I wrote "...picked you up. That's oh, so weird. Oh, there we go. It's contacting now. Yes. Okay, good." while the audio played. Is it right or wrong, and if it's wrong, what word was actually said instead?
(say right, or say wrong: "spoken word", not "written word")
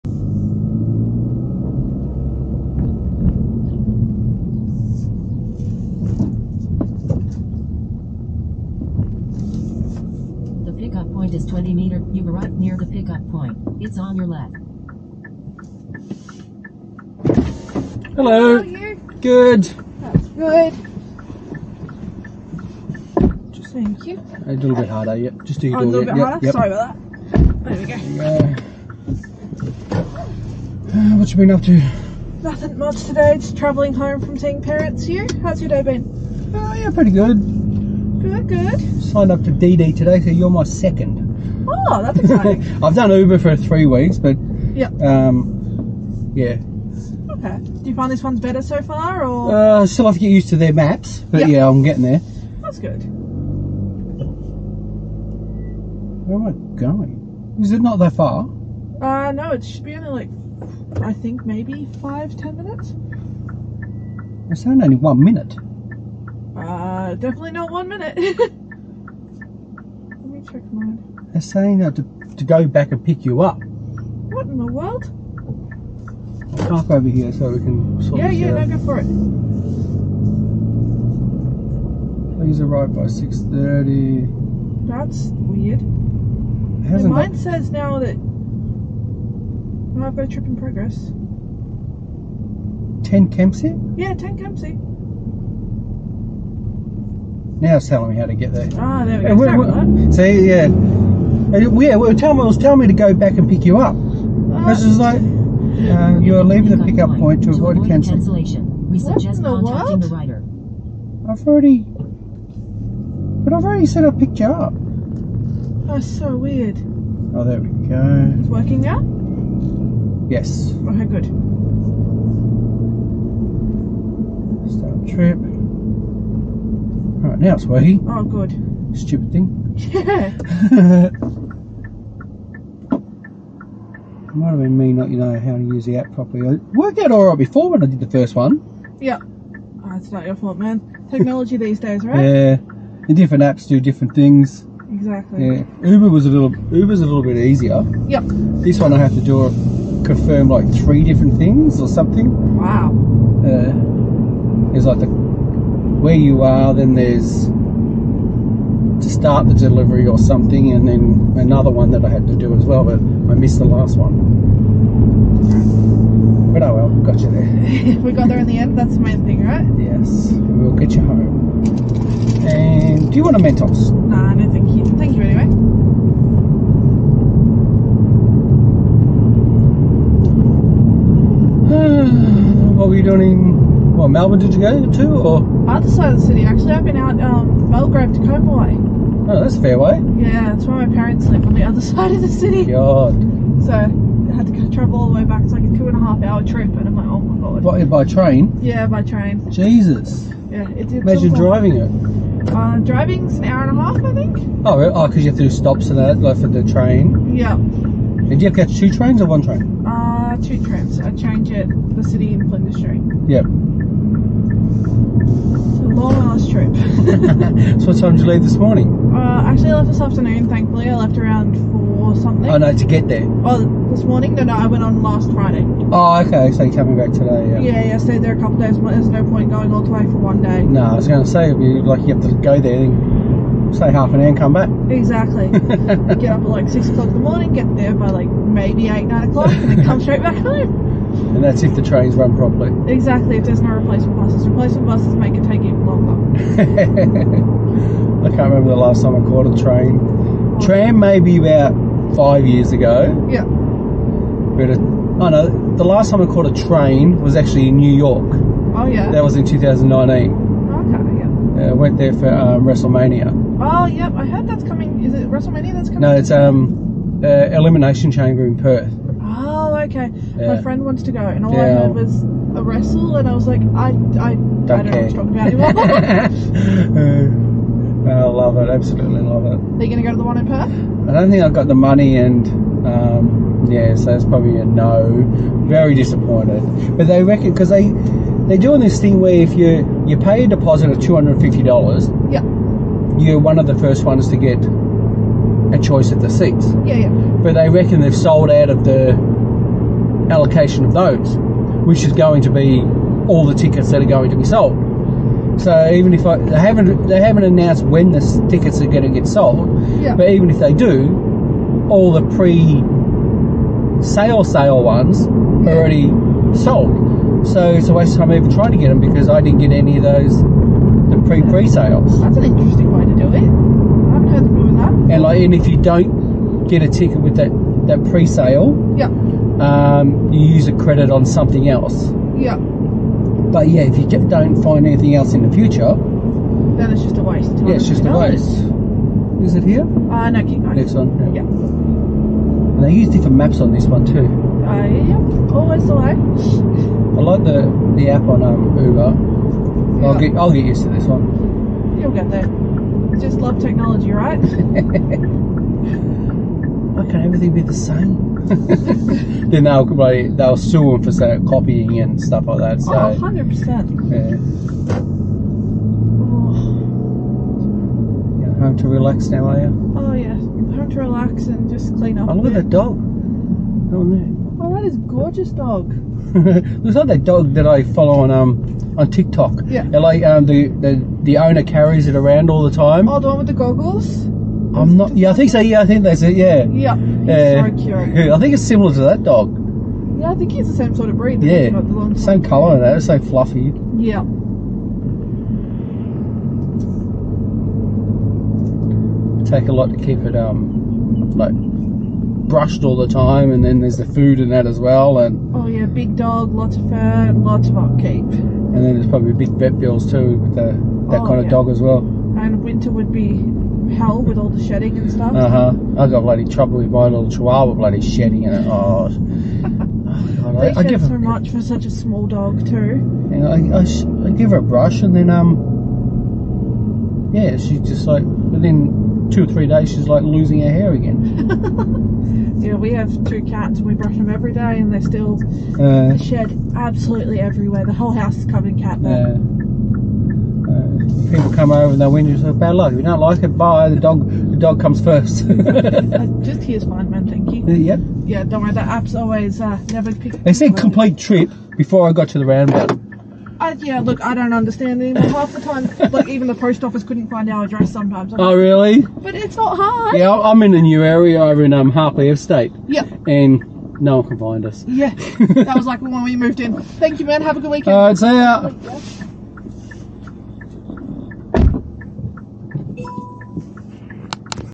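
wrong: "working", not "contacting".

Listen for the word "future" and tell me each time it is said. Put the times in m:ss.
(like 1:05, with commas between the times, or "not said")
5:35.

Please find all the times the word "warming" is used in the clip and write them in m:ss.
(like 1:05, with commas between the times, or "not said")
not said.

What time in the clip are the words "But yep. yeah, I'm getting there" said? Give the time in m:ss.
0:51.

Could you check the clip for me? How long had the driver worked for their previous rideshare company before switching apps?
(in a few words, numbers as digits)
3 weeks.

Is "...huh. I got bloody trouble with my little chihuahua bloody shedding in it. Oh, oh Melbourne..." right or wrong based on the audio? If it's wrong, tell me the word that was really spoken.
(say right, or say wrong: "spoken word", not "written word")
wrong: "God", not "Melbourne".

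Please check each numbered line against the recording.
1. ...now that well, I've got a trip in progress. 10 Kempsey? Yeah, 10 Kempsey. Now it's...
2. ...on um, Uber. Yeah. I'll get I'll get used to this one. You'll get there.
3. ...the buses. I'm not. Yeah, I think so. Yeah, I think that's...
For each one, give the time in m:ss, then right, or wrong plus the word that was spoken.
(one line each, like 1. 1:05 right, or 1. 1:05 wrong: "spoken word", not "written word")
1. 1:27 right
2. 5:48 right
3. 6:23 wrong: "goggles", not "buses".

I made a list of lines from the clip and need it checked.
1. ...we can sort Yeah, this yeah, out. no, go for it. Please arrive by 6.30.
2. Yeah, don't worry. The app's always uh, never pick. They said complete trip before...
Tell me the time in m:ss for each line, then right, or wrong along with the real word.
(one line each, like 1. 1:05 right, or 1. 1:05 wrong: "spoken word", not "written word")
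1. 1:17 right
2. 7:28 right.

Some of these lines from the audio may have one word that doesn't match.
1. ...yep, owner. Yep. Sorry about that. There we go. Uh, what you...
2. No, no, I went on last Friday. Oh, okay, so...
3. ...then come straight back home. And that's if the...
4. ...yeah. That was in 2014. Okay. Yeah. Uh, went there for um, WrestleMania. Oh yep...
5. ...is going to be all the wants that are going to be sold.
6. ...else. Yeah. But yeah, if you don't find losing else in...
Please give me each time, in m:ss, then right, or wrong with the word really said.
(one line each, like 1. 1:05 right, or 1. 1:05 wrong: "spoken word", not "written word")
1. 0:26 wrong: "harder", not "owner"
2. 3:44 right
3. 3:59 right
4. 4:18 wrong: "2019", not "2014"
5. 5:02 wrong: "tickets", not "wants"
6. 5:31 wrong: "anything", not "losing".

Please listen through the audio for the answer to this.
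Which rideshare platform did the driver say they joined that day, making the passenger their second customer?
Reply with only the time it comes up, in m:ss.
0:39.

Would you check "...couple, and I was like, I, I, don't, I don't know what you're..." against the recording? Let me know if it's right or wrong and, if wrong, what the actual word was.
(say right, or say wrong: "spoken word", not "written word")
wrong: "wrestle", not "couple".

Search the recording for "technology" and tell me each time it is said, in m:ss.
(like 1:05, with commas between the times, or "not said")
2:21, 5:53.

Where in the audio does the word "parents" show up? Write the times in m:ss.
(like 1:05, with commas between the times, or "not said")
0:34, 3:10.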